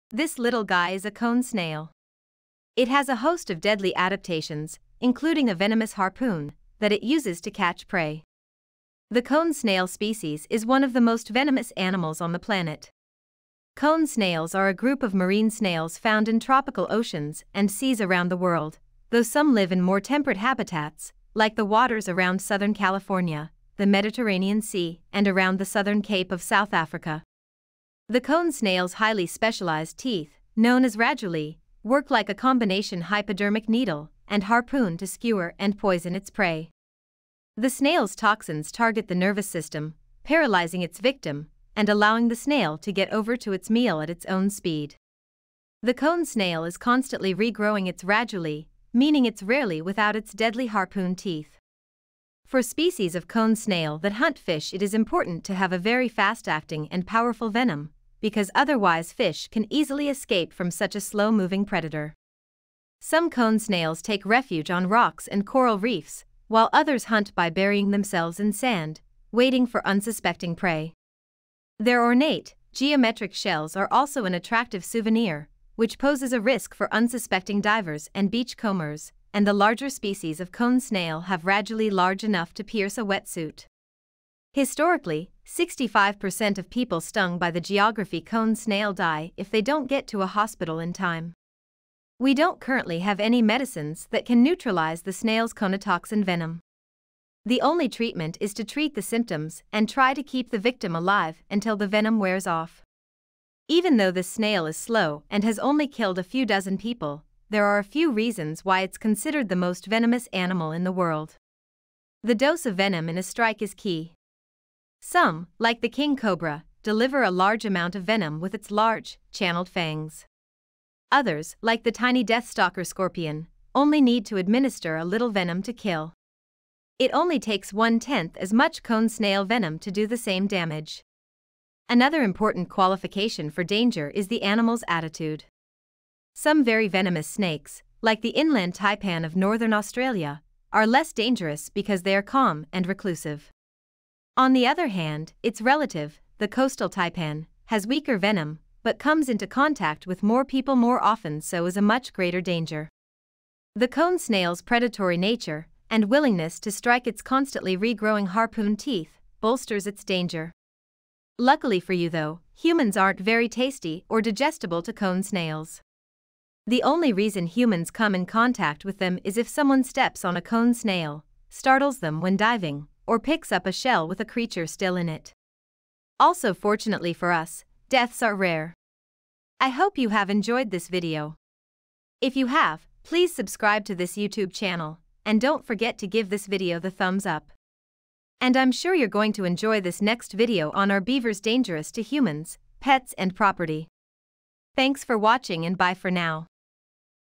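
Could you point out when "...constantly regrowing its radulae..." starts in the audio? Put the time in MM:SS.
00:46.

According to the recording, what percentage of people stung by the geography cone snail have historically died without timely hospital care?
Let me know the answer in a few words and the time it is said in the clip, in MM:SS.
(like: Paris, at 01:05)
65%, at 01:25.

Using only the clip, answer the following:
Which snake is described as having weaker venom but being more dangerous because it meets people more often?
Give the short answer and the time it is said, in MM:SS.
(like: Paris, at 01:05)
coastal taipan, at 02:26.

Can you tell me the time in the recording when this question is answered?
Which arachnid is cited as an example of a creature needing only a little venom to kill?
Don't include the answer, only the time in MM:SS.
02:02.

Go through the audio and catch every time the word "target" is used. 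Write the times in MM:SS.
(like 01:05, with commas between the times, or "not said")
00:38.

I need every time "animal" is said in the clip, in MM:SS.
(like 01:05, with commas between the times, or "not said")
00:11, 01:50, 02:14.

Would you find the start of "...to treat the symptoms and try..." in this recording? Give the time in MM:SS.
01:38.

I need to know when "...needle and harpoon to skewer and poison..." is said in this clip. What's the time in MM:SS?
00:33.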